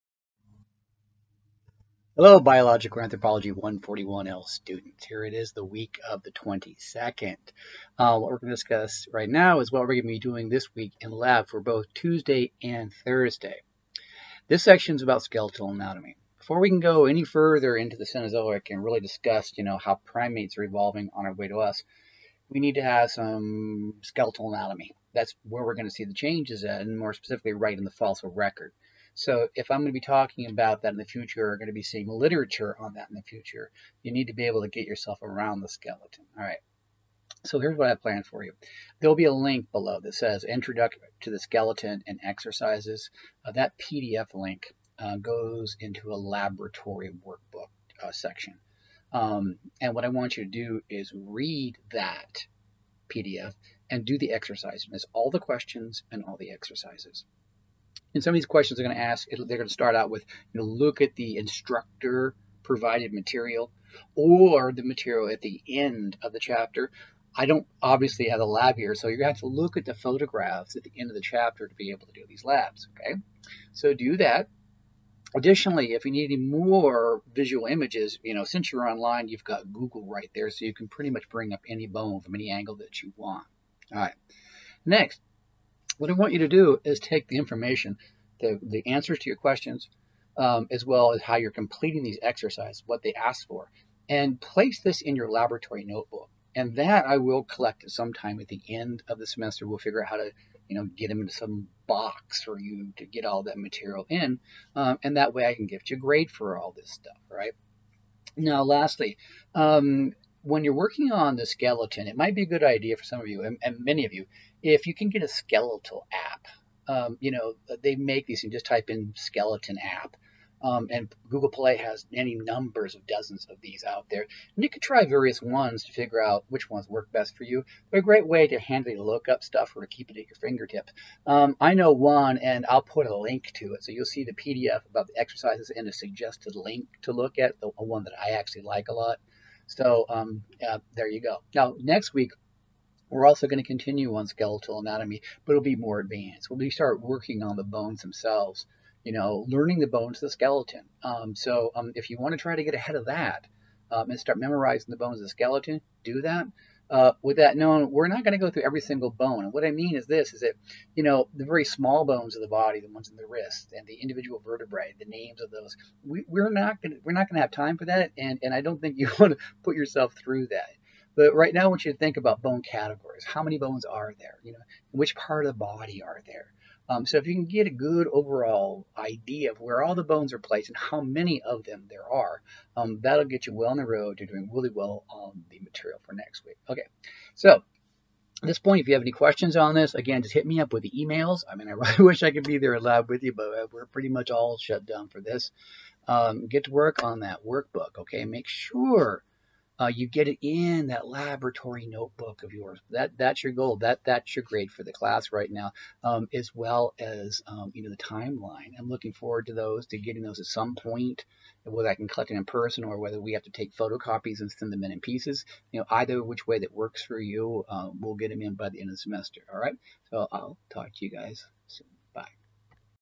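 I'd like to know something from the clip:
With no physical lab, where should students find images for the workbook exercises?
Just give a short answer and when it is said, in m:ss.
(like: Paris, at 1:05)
Photographs at the end of the chapter, at 1:09.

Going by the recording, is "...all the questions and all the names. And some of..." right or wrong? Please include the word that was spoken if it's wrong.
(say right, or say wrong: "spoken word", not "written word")
wrong: "exercises", not "names".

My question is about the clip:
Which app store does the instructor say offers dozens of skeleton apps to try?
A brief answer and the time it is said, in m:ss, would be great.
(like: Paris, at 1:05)
Google Play, at 2:01.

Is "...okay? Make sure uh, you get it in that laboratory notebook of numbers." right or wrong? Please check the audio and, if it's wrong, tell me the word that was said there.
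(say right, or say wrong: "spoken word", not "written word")
wrong: "yours", not "numbers".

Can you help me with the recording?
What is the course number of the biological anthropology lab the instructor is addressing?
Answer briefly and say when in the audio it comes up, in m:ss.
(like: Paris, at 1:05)
141L, at 0:03.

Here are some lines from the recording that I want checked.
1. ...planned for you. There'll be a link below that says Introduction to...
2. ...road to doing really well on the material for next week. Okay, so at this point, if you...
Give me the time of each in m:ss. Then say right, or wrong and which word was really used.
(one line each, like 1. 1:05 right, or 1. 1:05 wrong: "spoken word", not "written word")
1. 0:38 right
2. 3:03 right.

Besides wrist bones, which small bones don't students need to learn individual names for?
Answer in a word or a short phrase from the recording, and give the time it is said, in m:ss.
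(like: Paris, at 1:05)
Vertebrae, at 2:43.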